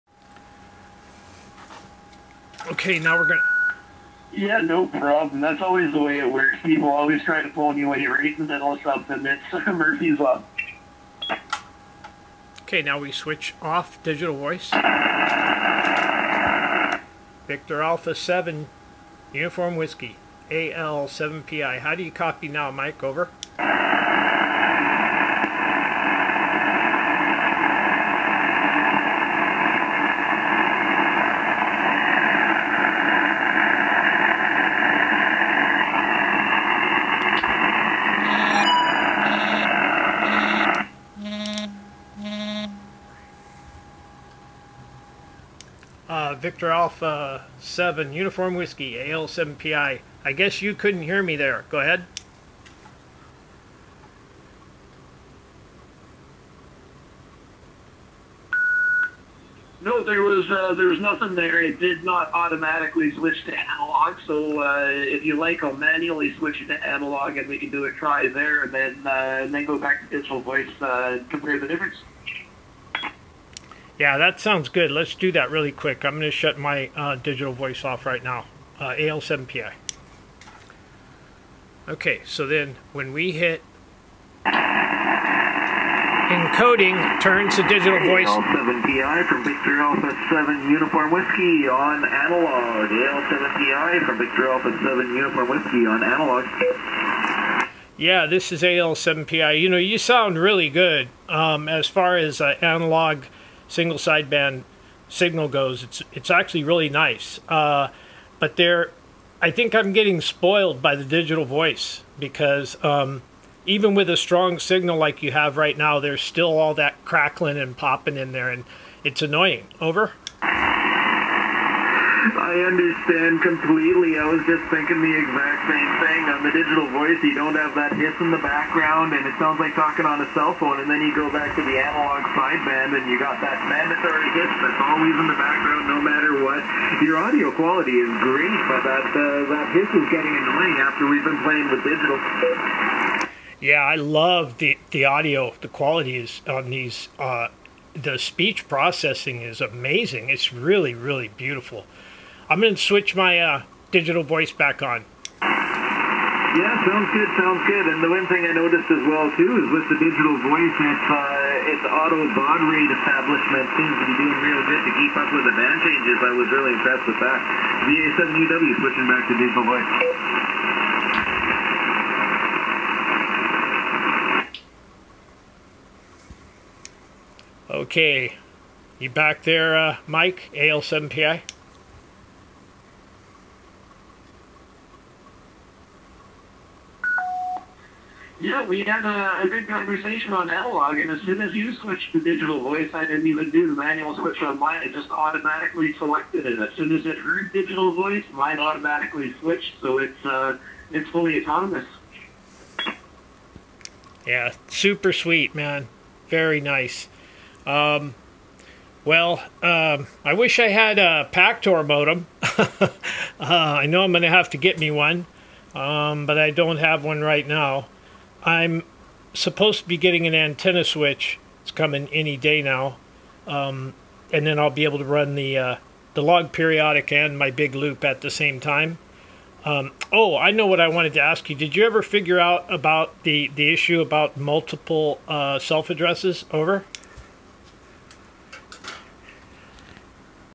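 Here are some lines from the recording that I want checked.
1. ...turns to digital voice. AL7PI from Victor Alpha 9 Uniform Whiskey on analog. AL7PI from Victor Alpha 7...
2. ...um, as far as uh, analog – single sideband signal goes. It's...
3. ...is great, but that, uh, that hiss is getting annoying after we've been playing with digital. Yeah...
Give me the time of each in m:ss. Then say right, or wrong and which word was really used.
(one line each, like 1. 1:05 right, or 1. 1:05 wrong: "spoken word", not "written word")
1. 1:27 wrong: "7", not "9"
2. 1:41 right
3. 2:18 right.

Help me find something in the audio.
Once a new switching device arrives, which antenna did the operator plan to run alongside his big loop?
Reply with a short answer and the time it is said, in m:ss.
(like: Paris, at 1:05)
Log periodic, at 3:46.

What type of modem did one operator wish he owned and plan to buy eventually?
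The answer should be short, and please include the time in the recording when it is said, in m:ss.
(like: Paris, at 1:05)
Pactor modem, at 3:31.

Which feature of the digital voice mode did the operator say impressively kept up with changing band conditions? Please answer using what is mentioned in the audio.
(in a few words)
Auto baud rate establishment.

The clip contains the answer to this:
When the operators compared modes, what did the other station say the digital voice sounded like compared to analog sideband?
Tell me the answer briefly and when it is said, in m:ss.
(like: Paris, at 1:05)
Talking on a cell phone, at 2:09.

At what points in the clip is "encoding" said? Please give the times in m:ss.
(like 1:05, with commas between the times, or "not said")
1:24.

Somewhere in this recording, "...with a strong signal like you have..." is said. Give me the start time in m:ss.
1:53.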